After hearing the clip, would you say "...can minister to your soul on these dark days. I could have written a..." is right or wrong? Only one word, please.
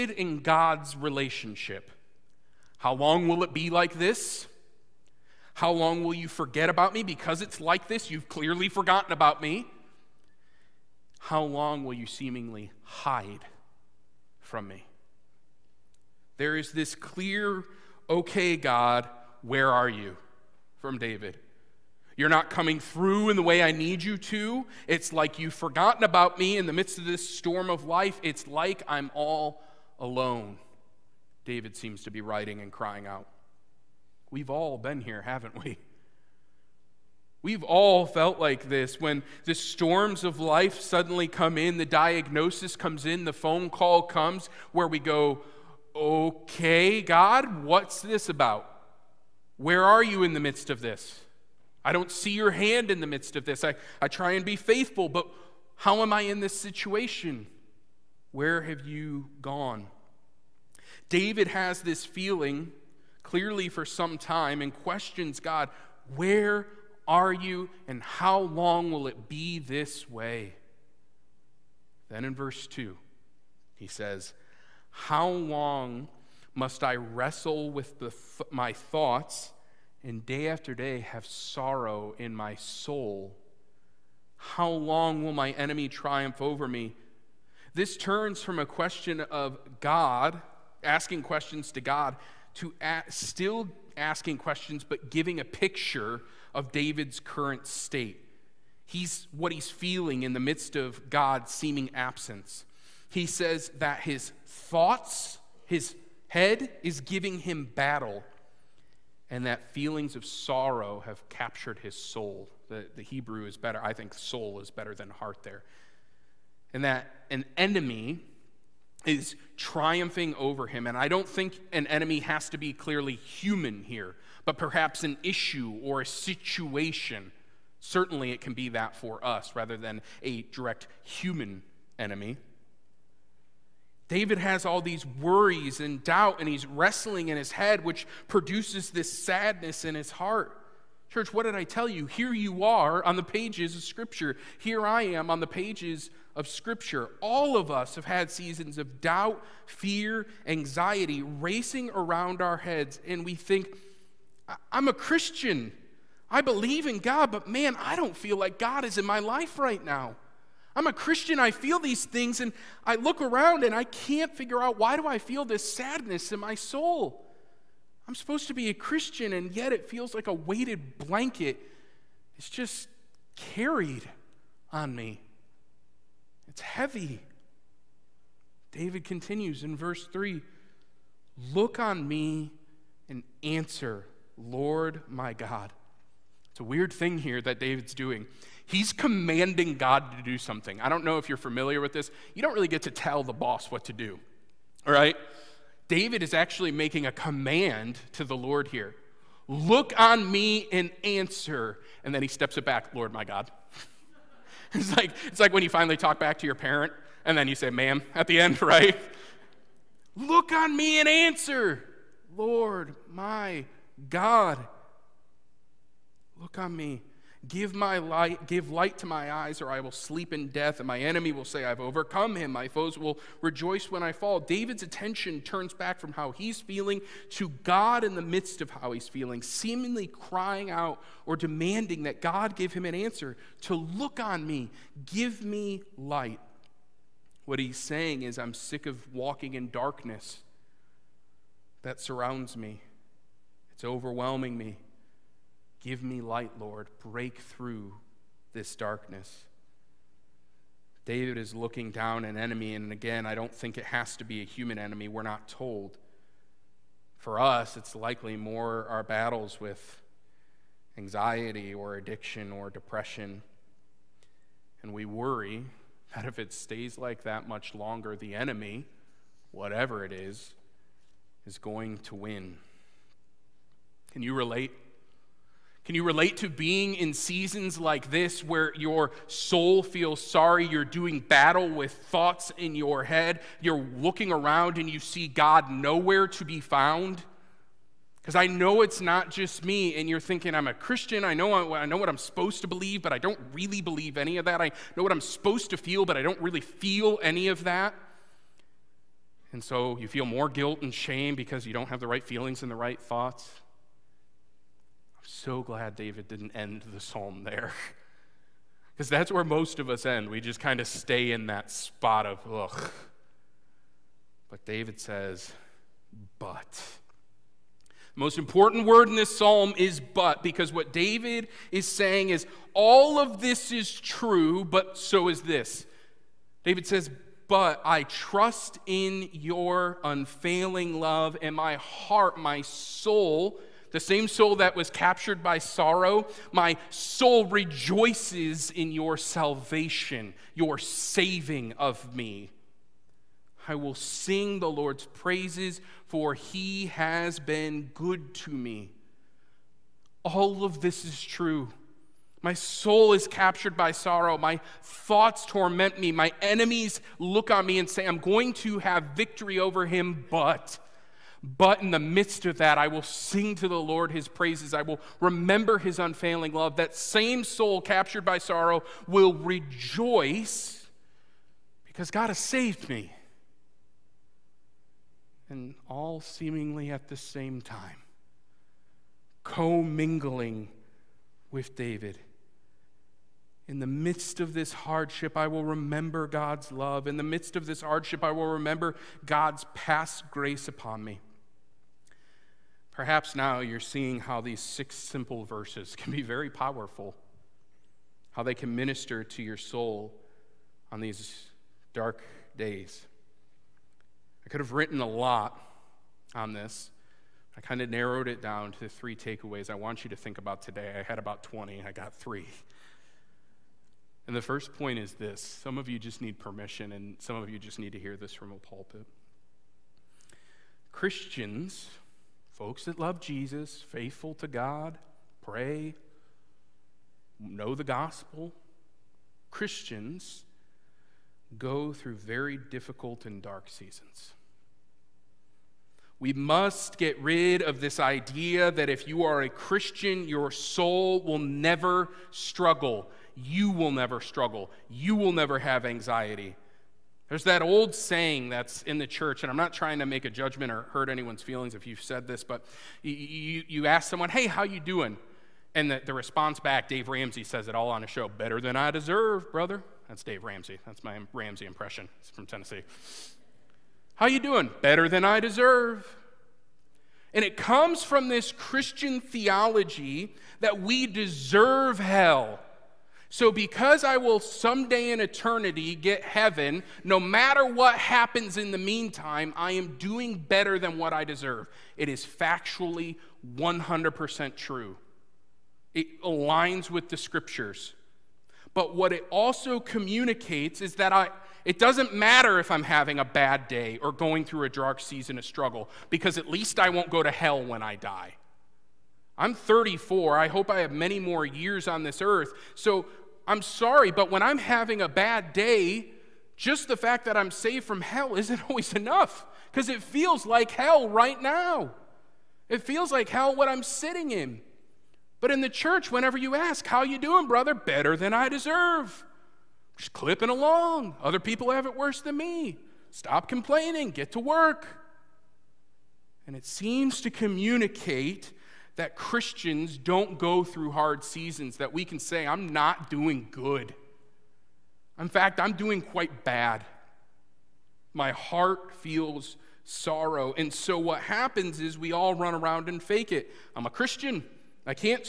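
right.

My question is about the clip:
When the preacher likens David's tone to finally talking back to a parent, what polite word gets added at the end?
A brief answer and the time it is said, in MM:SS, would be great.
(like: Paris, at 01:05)
ma'am, at 03:27.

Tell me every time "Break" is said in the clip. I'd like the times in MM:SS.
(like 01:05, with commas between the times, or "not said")
04:06.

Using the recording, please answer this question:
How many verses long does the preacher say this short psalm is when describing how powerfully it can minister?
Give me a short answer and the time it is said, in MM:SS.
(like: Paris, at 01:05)
6, at 06:34.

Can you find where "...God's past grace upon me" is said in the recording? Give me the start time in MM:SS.
06:29.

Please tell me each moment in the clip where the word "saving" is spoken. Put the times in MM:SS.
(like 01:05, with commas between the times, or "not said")
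05:40.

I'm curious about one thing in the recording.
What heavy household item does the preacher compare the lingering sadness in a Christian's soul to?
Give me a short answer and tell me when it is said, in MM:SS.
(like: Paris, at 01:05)
weighted blanket, at 02:50.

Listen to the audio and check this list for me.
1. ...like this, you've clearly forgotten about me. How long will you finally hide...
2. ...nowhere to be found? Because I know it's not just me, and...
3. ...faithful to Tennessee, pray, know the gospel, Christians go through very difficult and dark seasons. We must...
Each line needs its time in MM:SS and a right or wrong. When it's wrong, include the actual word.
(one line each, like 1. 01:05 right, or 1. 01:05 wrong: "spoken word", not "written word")
1. 00:07 wrong: "seemingly", not "finally"
2. 04:45 right
3. 07:03 wrong: "God", not "Tennessee".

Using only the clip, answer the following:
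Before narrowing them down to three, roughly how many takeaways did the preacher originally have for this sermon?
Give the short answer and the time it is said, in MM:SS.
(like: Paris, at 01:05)
20, at 06:51.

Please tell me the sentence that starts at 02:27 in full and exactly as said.
All of us have had seasons of doubt, fear, anxiety racing around our heads, and we think, I'm a Christian.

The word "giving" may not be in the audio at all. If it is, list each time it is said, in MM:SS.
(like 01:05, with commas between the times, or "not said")
01:35, 01:47.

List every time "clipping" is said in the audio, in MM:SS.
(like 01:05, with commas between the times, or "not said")
08:40.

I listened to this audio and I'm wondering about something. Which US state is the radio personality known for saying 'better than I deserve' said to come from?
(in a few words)
Tennessee.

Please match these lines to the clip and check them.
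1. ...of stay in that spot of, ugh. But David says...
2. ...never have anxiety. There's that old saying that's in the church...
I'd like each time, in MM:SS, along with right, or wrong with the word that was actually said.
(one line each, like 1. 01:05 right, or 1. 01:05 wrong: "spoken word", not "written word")
1. 05:10 right
2. 07:25 right.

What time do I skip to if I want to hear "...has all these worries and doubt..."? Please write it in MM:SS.
02:14.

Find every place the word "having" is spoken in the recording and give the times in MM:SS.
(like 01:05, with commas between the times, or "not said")
08:12, 08:24.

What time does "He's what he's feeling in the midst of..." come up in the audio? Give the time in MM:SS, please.
01:38.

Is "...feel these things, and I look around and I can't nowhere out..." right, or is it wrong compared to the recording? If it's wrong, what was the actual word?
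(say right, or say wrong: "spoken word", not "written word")
wrong: "figure", not "nowhere".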